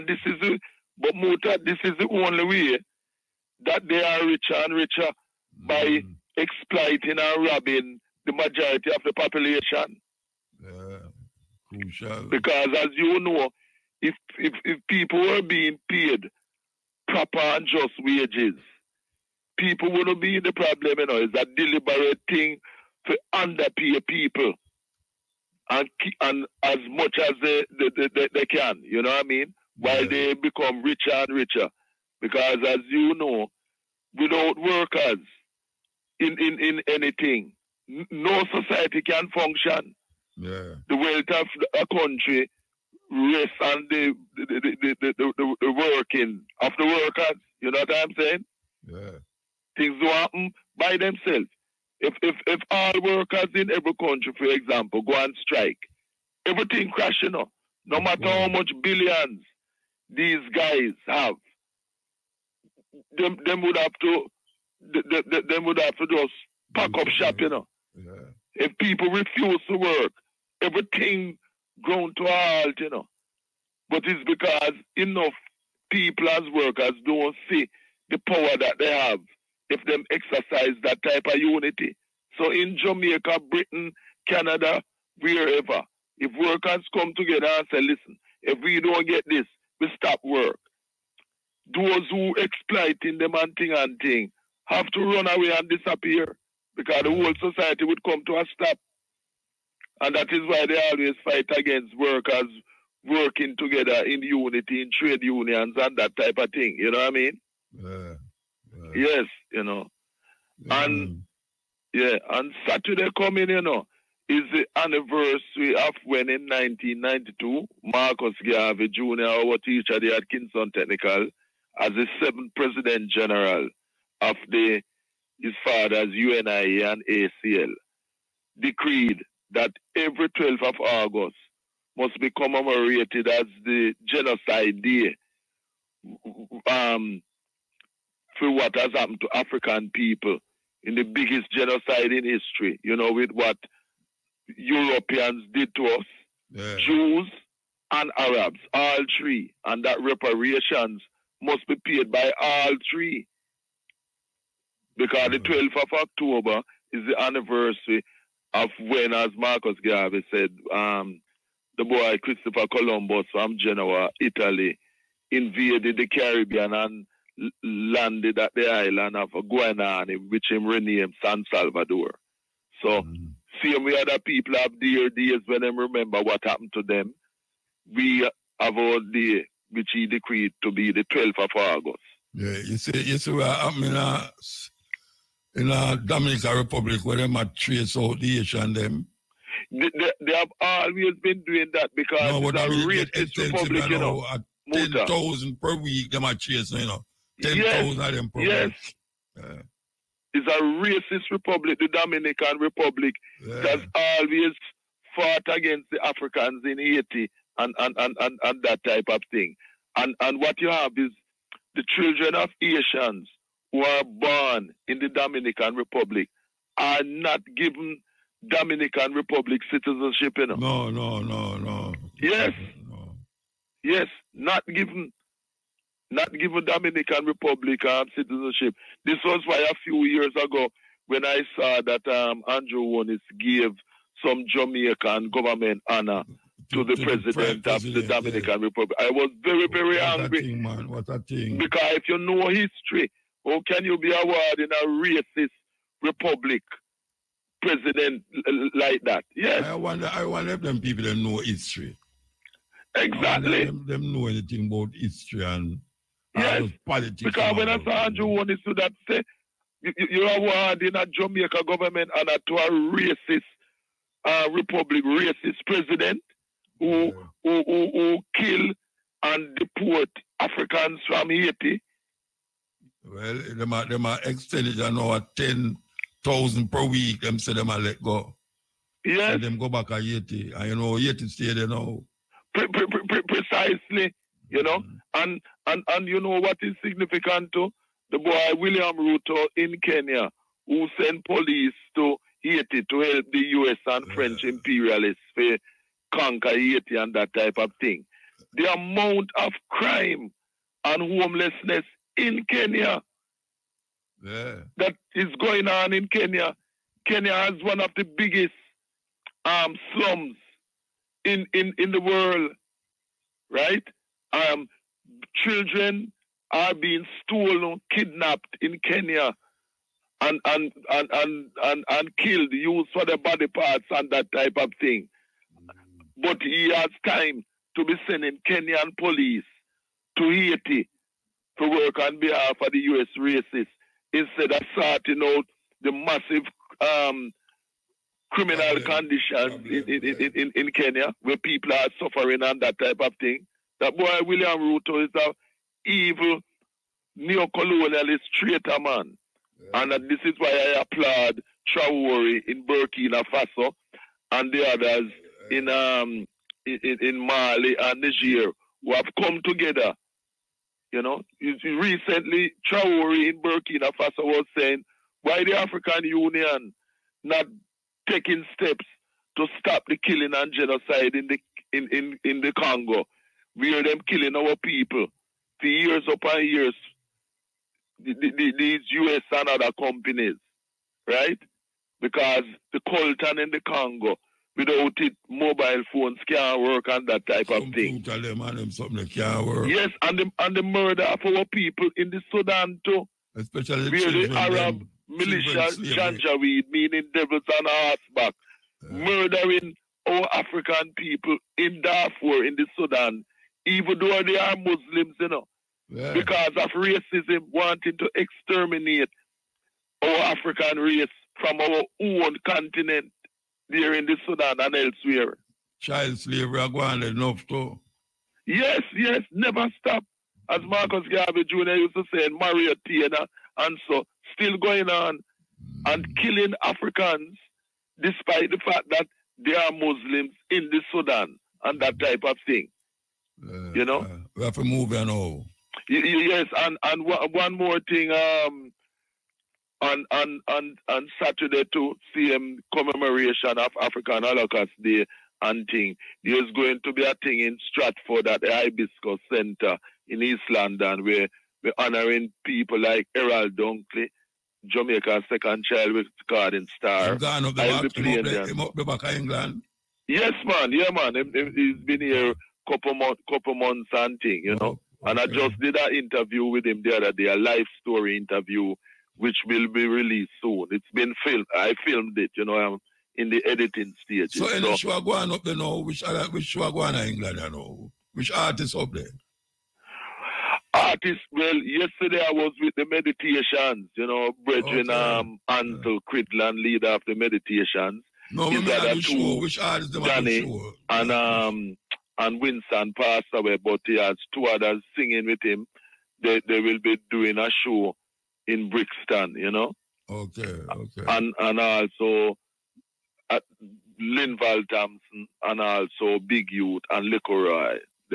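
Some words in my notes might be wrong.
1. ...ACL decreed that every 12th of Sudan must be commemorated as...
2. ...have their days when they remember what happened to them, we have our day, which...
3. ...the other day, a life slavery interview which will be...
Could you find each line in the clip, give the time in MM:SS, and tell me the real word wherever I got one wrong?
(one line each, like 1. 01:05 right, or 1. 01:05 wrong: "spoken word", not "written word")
1. 02:07 wrong: "August", not "Sudan"
2. 02:54 right
3. 07:46 wrong: "story", not "slavery".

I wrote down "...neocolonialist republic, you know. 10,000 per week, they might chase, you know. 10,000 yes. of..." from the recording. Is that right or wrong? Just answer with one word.
wrong.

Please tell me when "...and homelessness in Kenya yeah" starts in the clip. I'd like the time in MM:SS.
05:00.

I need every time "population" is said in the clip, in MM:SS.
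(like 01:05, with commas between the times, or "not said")
00:09.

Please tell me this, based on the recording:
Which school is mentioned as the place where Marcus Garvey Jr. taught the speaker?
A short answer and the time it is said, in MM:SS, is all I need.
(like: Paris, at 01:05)
Atkinson Technical, at 02:00.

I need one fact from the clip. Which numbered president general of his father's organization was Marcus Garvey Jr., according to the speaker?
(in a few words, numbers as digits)
seventh.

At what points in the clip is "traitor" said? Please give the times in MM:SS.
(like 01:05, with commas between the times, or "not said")
05:48.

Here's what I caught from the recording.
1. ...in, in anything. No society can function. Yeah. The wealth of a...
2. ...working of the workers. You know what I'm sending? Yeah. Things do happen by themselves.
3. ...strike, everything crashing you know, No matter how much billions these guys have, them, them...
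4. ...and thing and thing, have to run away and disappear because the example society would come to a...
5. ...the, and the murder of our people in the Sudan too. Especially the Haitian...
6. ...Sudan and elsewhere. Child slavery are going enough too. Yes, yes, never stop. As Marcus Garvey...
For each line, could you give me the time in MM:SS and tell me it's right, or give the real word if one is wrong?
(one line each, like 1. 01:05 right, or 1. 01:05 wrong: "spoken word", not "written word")
1. 00:36 right
2. 00:45 wrong: "saying", not "sending"
3. 00:55 right
4. 01:33 wrong: "whole", not "example"
5. 06:30 wrong: "Arab", not "Haitian"
6. 06:54 right.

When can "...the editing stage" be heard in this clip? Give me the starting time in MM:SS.
07:53.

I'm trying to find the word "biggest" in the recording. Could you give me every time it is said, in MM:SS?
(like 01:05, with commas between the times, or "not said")
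02:21, 05:08.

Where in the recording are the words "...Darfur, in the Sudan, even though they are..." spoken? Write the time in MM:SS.
06:41.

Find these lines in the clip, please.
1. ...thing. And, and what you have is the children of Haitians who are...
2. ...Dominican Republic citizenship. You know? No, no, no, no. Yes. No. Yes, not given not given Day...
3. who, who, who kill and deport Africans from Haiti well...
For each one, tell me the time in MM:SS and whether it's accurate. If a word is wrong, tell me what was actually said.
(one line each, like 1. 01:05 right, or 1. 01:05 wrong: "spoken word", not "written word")
1. 03:29 right
2. 03:38 wrong: "Dominican", not "Day"
3. 04:27 right.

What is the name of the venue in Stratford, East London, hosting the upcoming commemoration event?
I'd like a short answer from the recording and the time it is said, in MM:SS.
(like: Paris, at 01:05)
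Hibiscus Center, at 07:28.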